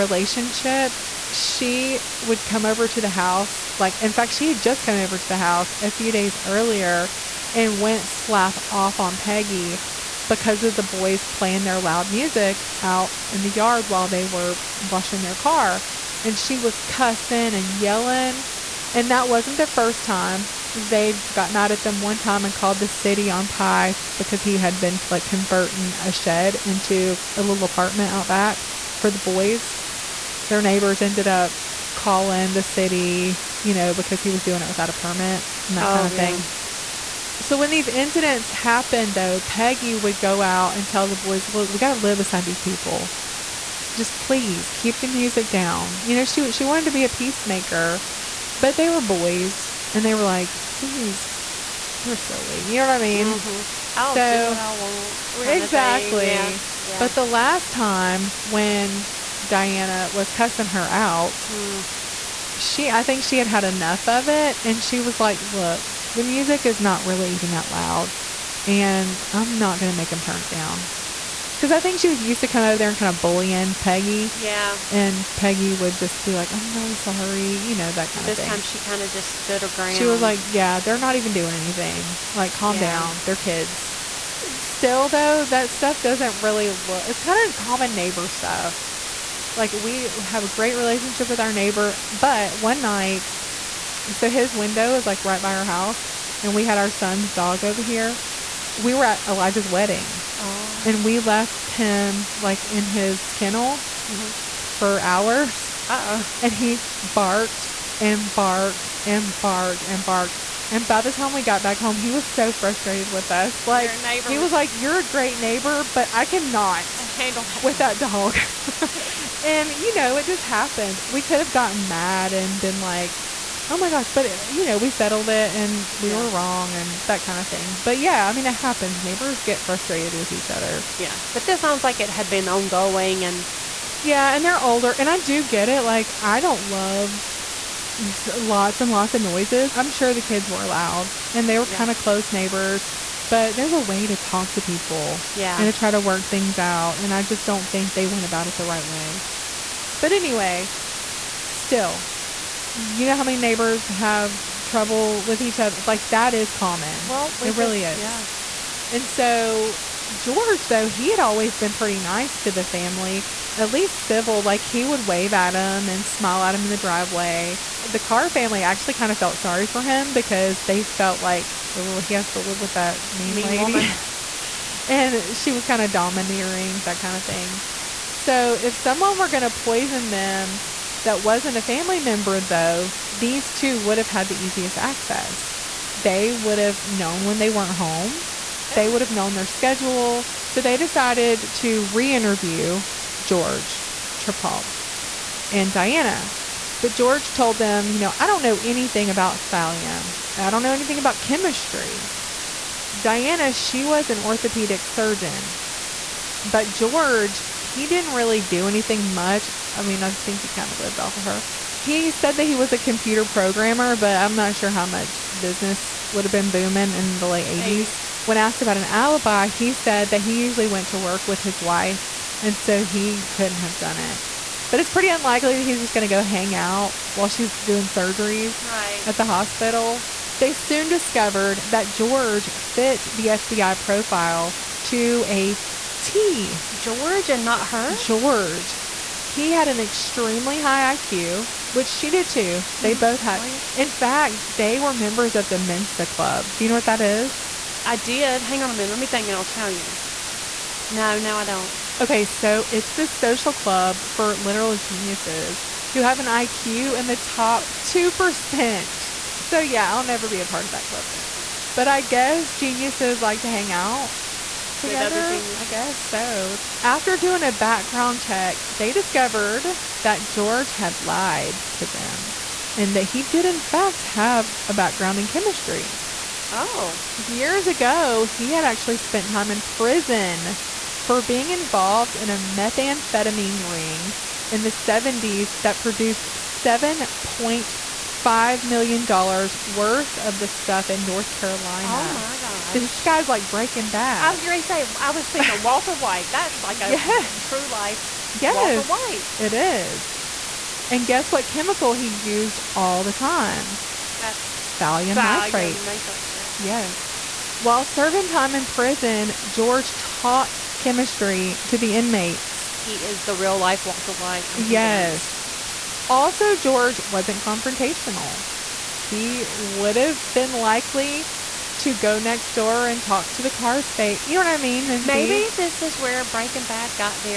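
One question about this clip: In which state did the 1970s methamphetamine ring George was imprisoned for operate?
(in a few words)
North Carolina.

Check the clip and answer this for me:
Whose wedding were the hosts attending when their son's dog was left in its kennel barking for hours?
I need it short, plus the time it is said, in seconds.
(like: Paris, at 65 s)
Elijah's, at 99 s.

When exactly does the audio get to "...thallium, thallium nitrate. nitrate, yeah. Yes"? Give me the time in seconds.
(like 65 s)
304 s.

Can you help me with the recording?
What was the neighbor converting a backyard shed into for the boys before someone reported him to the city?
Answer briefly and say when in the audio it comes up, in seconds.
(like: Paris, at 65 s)
A little apartment, at 27 s.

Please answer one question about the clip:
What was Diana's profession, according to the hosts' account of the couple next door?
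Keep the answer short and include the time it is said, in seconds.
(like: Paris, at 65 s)
Orthopedic surgeon, at 204 s.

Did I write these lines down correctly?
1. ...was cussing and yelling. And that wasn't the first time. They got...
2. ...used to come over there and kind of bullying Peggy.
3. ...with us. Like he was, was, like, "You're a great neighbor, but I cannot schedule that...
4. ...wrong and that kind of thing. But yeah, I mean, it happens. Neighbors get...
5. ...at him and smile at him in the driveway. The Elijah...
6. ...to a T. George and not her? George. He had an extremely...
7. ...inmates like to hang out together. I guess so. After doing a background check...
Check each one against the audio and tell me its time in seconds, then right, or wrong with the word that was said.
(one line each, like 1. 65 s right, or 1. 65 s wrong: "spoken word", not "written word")
1. 16 s right
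2. 72 s right
3. 113 s wrong: "handle", not "schedule"
4. 126 s right
5. 165 s wrong: "Carr", not "Elijah"
6. 234 s right
7. 262 s wrong: "geniuses", not "inmates".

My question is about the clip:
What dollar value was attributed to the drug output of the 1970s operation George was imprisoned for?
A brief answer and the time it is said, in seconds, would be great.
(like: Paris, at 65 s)
$7.5 million, at 286 s.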